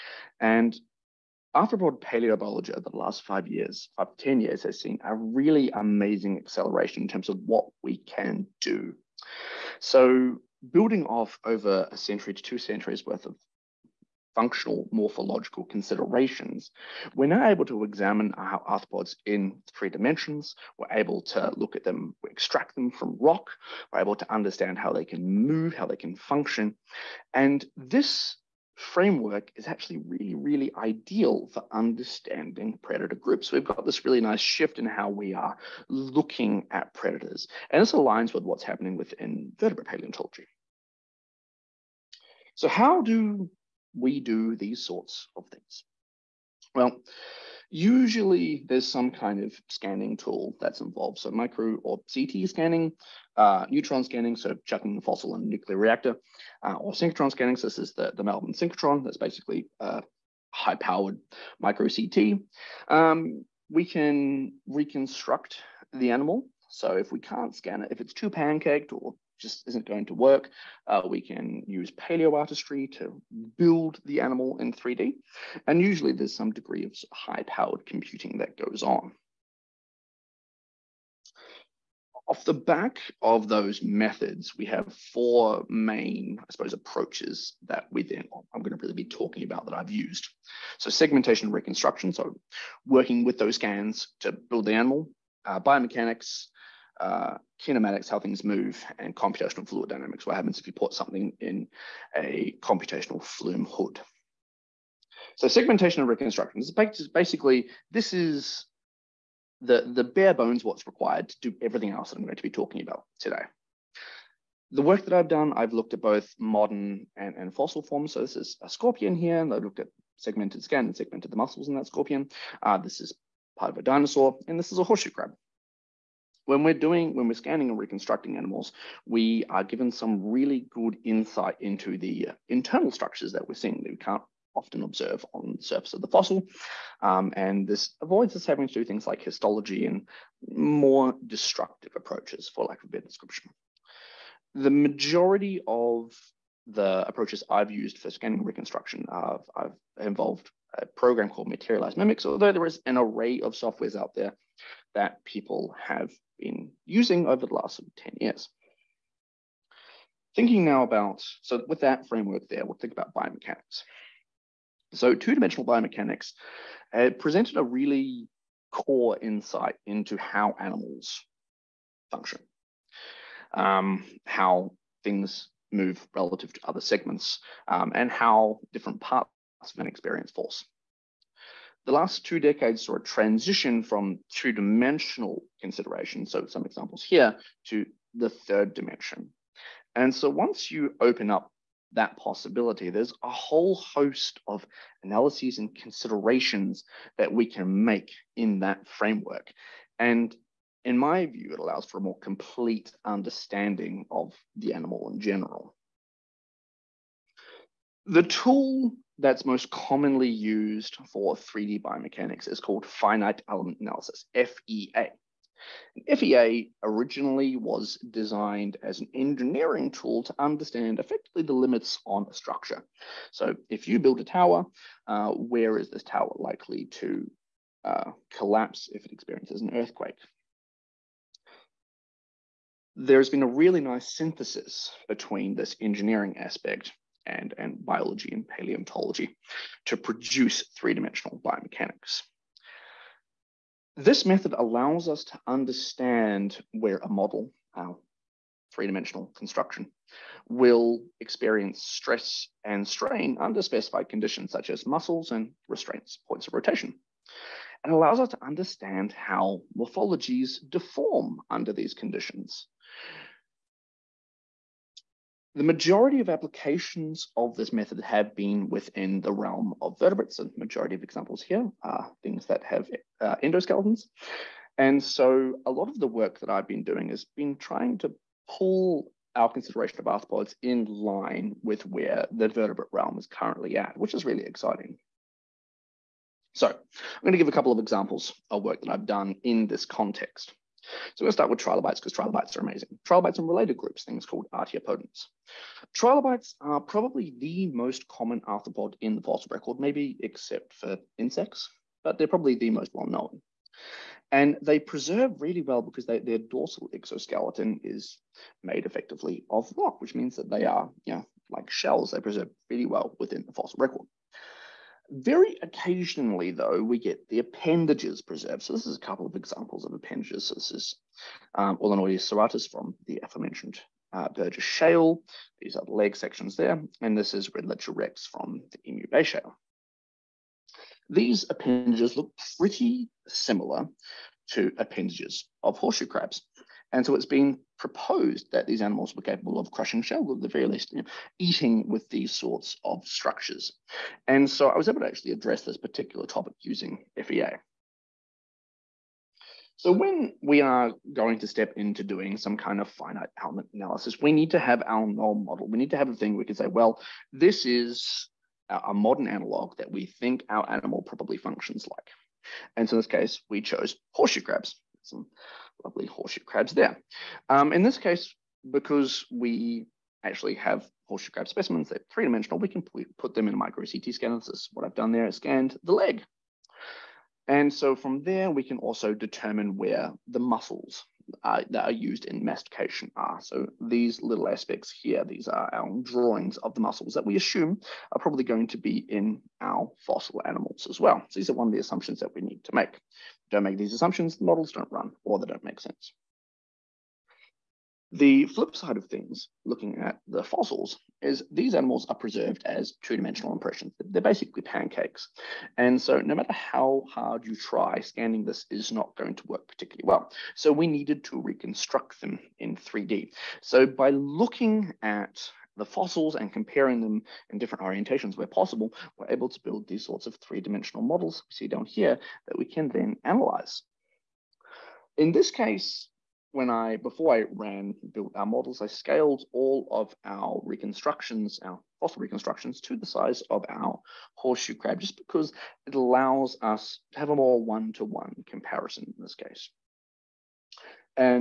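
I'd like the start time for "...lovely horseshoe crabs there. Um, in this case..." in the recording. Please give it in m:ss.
6:05.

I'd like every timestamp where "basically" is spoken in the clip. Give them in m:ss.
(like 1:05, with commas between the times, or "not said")
0:59, 1:47, 6:44.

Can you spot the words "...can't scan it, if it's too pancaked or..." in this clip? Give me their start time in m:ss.
1:07.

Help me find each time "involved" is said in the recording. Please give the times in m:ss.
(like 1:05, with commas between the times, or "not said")
0:50, 2:30.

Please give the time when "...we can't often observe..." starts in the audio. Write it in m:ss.
2:13.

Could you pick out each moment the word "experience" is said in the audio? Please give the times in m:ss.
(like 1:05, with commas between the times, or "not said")
2:59, 3:49, 4:11.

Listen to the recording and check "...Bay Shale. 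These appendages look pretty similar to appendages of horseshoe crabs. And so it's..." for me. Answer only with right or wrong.
right.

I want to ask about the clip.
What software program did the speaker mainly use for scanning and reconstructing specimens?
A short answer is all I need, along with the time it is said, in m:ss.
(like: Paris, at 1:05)
Materialise Mimics, at 2:31.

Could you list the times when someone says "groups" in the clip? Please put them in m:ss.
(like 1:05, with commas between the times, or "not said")
0:33, 4:53.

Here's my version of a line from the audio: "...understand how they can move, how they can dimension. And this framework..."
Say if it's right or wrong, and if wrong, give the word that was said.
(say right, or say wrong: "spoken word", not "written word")
wrong: "function", not "dimension".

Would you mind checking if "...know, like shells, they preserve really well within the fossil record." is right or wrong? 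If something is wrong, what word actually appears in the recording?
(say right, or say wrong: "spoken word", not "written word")
right.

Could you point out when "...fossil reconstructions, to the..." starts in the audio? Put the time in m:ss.
7:11.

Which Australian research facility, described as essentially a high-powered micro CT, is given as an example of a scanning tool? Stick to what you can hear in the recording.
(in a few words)
Melbourne synchrotron.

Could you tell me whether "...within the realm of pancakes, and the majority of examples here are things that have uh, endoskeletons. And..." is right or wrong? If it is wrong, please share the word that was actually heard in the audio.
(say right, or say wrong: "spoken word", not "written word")
wrong: "vertebrates", not "pancakes".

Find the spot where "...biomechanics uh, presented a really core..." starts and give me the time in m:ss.
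2:45.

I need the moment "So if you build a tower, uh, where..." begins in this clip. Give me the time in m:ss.
3:43.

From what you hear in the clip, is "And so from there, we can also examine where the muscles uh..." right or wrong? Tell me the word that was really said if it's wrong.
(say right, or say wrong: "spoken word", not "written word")
wrong: "determine", not "examine".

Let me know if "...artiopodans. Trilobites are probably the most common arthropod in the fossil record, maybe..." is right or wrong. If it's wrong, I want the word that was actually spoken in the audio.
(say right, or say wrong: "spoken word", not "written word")
right.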